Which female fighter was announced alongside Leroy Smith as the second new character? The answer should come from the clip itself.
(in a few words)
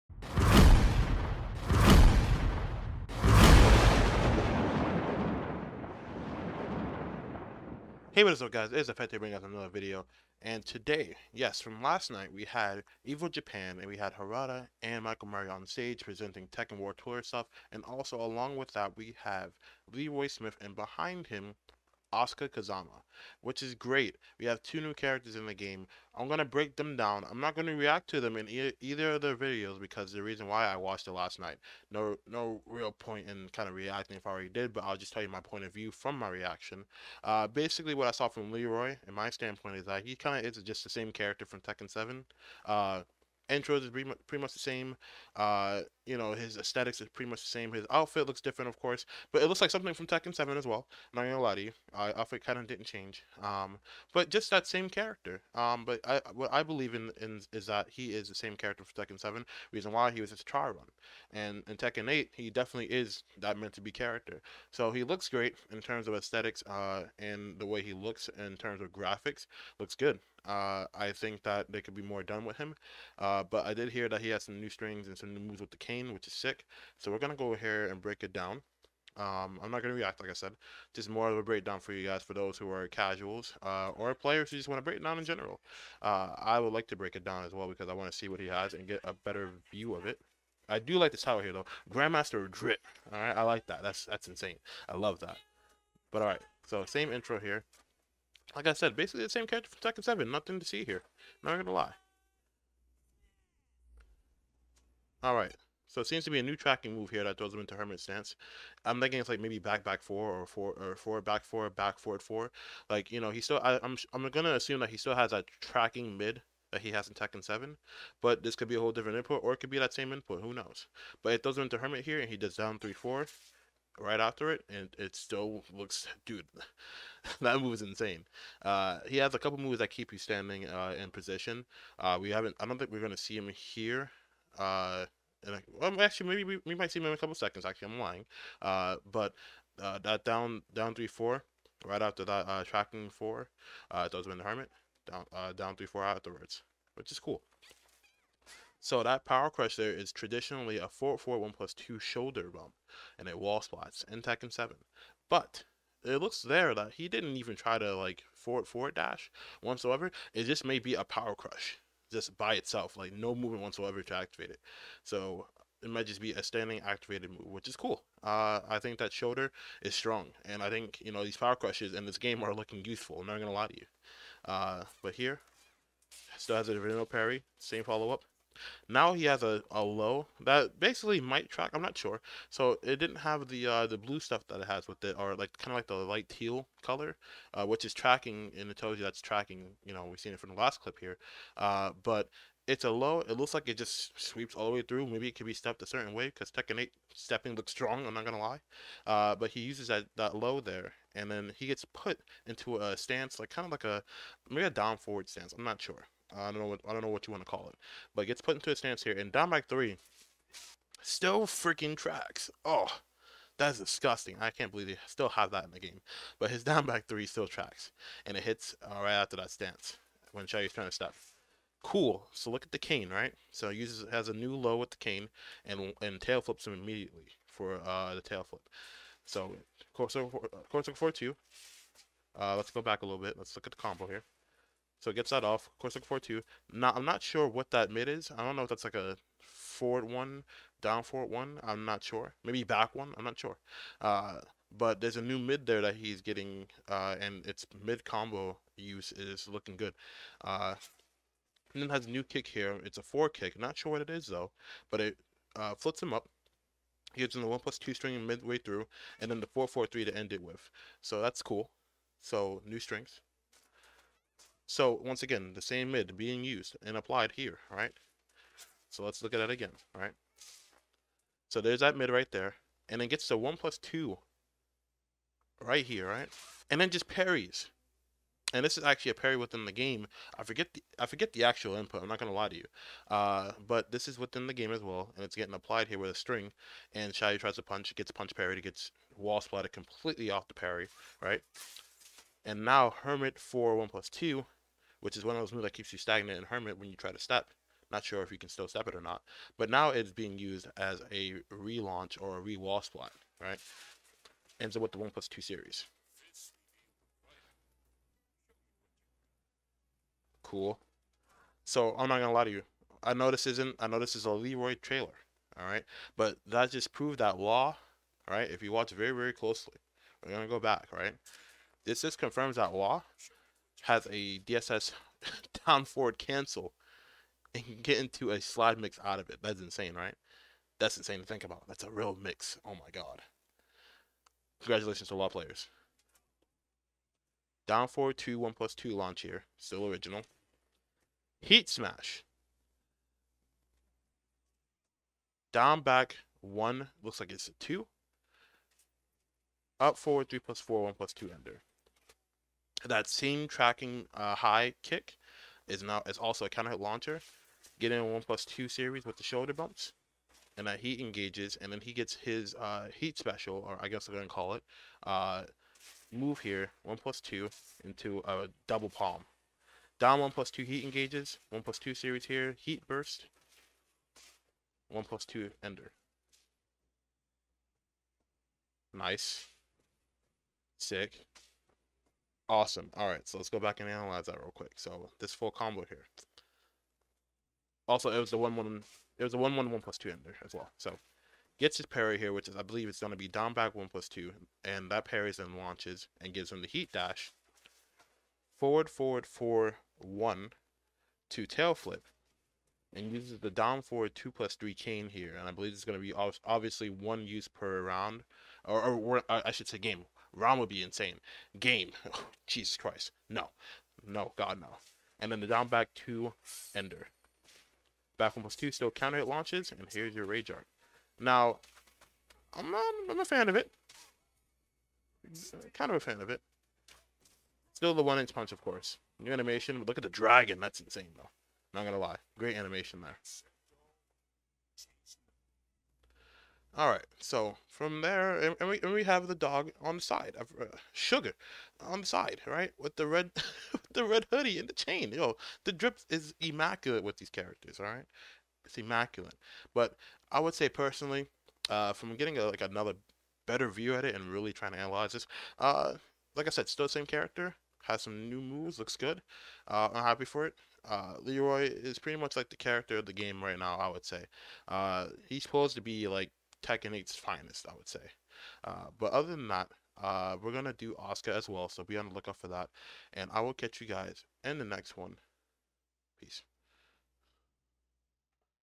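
Asuka Kazama.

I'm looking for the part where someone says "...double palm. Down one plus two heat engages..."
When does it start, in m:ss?
6:08.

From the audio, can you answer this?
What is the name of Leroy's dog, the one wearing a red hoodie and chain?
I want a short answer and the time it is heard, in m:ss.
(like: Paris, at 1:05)
Sugar, at 7:20.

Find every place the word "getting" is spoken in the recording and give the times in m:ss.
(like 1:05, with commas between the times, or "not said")
4:06, 4:45, 7:32.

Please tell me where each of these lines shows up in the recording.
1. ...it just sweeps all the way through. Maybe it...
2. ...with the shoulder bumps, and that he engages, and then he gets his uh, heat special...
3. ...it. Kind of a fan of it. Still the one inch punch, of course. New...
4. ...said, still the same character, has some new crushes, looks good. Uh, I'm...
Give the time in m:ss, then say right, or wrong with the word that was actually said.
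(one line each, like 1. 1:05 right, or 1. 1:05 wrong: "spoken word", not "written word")
1. 3:13 right
2. 5:59 right
3. 7:03 right
4. 7:36 wrong: "moves", not "crushes".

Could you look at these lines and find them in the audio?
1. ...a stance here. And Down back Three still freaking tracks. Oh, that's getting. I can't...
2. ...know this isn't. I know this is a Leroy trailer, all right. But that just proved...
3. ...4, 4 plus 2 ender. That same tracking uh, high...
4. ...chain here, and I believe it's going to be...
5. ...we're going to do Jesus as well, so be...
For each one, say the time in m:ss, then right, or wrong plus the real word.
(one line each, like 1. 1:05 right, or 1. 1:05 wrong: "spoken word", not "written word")
1. 3:28 wrong: "disgusting", not "getting"
2. 5:13 right
3. 5:50 wrong: "1", not "4"
4. 6:44 right
5. 7:50 wrong: "Asuka", not "Jesus".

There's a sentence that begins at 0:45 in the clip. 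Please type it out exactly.
Uh, you know, his aesthetics is pretty much the same.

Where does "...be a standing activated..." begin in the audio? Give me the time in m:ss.
2:46.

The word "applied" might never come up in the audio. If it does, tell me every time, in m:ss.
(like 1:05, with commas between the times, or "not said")
4:26, 4:45.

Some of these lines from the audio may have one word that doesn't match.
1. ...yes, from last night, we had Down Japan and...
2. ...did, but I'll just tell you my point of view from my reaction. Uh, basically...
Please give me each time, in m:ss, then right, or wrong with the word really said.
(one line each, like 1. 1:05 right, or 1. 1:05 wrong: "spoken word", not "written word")
1. 0:11 wrong: "EVO", not "Down"
2. 0:34 right.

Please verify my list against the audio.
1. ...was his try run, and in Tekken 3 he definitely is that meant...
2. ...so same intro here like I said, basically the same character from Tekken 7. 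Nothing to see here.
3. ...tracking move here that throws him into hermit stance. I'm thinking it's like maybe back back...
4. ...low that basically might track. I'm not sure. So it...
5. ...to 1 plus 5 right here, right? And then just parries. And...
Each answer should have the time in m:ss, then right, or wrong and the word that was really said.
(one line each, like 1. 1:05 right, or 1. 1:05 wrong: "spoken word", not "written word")
1. 1:00 wrong: "8", not "3"
2. 1:36 right
3. 1:46 right
4. 2:59 right
5. 4:33 wrong: "2", not "5".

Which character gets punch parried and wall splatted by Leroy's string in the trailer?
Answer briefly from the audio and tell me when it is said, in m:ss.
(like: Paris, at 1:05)
Xiaoyu, at 4:47.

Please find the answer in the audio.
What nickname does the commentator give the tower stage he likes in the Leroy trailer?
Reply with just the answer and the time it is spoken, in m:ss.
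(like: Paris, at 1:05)
Grandmaster Drip, at 1:31.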